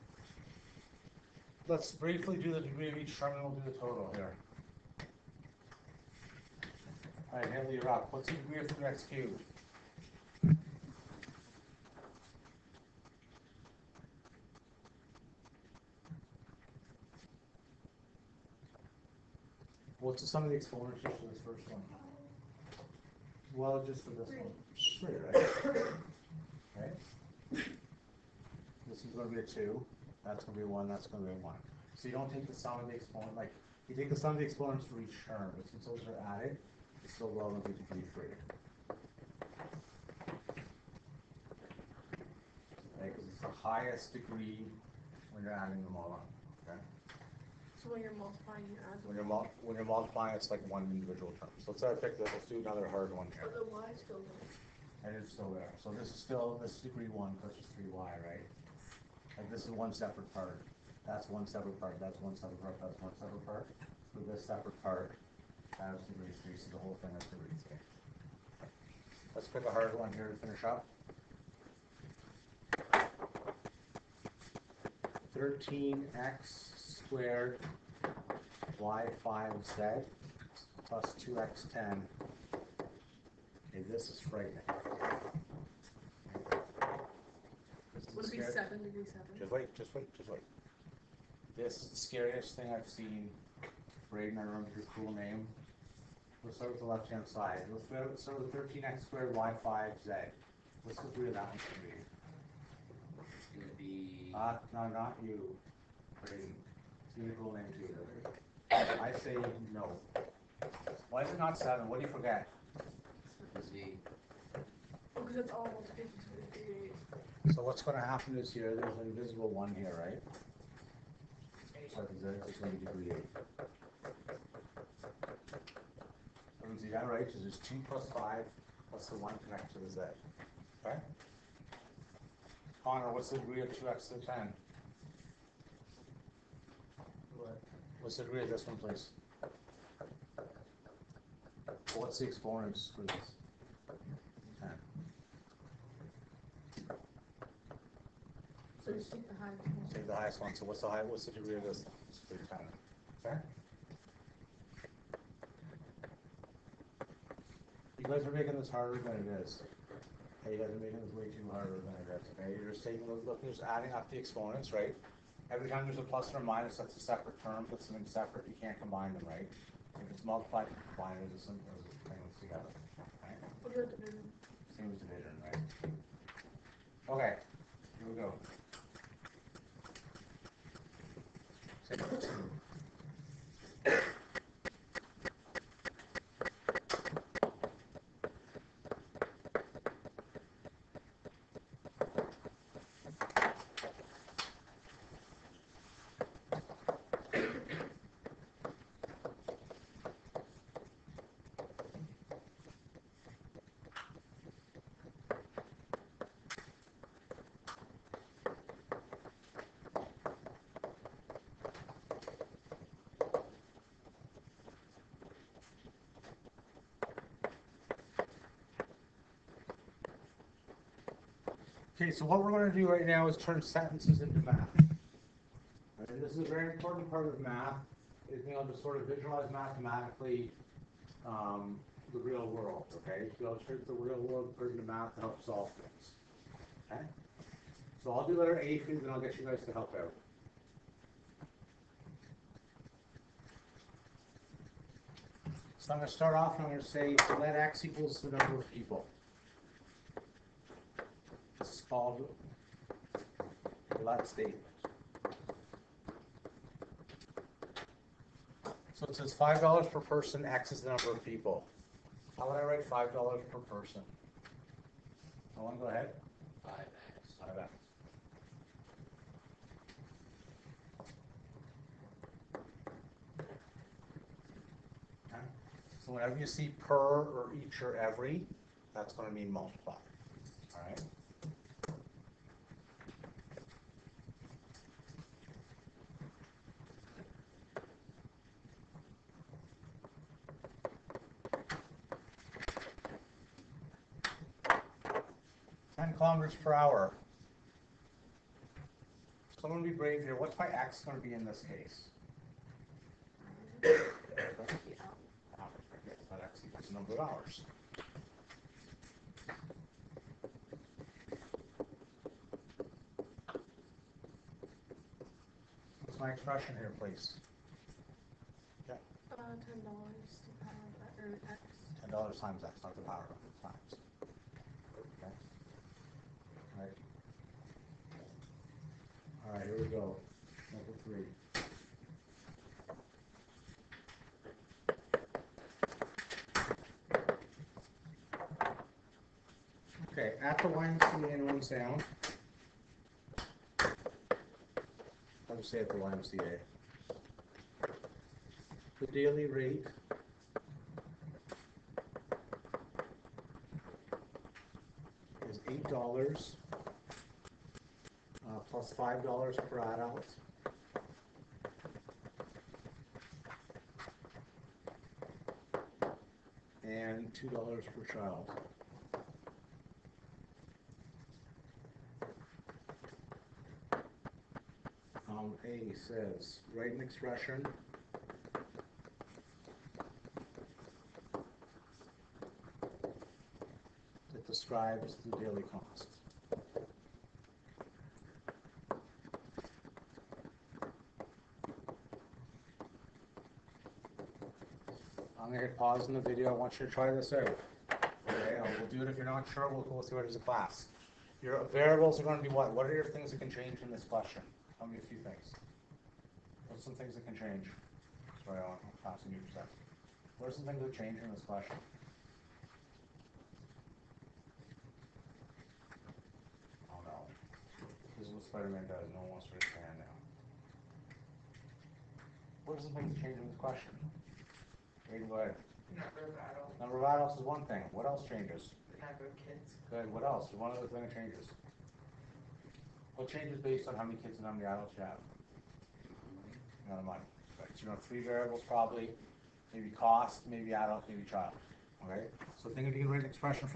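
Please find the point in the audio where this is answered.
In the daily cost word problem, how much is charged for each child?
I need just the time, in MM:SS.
06:07.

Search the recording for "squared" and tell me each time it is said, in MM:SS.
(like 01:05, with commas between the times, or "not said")
01:17, 01:39.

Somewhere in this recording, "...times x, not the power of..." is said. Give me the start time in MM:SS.
05:22.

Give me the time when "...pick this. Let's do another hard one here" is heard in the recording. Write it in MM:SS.
00:51.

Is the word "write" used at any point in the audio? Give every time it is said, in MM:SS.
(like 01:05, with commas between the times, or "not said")
04:22, 06:16, 07:23.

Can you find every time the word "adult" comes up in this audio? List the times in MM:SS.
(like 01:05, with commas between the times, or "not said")
05:59, 07:07, 07:14, 07:20.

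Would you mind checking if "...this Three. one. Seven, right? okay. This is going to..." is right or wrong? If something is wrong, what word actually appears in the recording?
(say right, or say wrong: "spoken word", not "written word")
wrong: "Three", not "Seven".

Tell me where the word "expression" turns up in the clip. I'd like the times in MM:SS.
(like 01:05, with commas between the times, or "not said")
05:16, 06:17, 07:23.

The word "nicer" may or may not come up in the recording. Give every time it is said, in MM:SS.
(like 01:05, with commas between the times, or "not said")
not said.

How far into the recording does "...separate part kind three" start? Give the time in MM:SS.
01:04.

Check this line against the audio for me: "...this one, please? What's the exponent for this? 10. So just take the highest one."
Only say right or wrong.
right.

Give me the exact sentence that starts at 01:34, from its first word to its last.
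Braden, I remember your cool name.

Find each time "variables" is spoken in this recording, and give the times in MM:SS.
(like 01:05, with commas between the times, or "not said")
06:41, 07:18.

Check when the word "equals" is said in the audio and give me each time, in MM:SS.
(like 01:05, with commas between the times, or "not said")
04:07, 05:06.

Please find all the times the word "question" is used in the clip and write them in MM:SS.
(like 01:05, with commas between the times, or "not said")
06:44, 06:51, 07:03.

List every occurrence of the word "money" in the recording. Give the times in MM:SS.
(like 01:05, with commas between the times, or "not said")
07:17.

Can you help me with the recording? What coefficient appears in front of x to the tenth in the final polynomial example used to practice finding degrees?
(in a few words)
2.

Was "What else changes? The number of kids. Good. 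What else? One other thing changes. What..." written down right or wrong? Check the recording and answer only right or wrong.
right.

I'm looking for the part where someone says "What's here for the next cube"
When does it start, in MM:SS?
00:08.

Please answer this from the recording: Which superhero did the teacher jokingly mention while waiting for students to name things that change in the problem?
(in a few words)
Spider-Man.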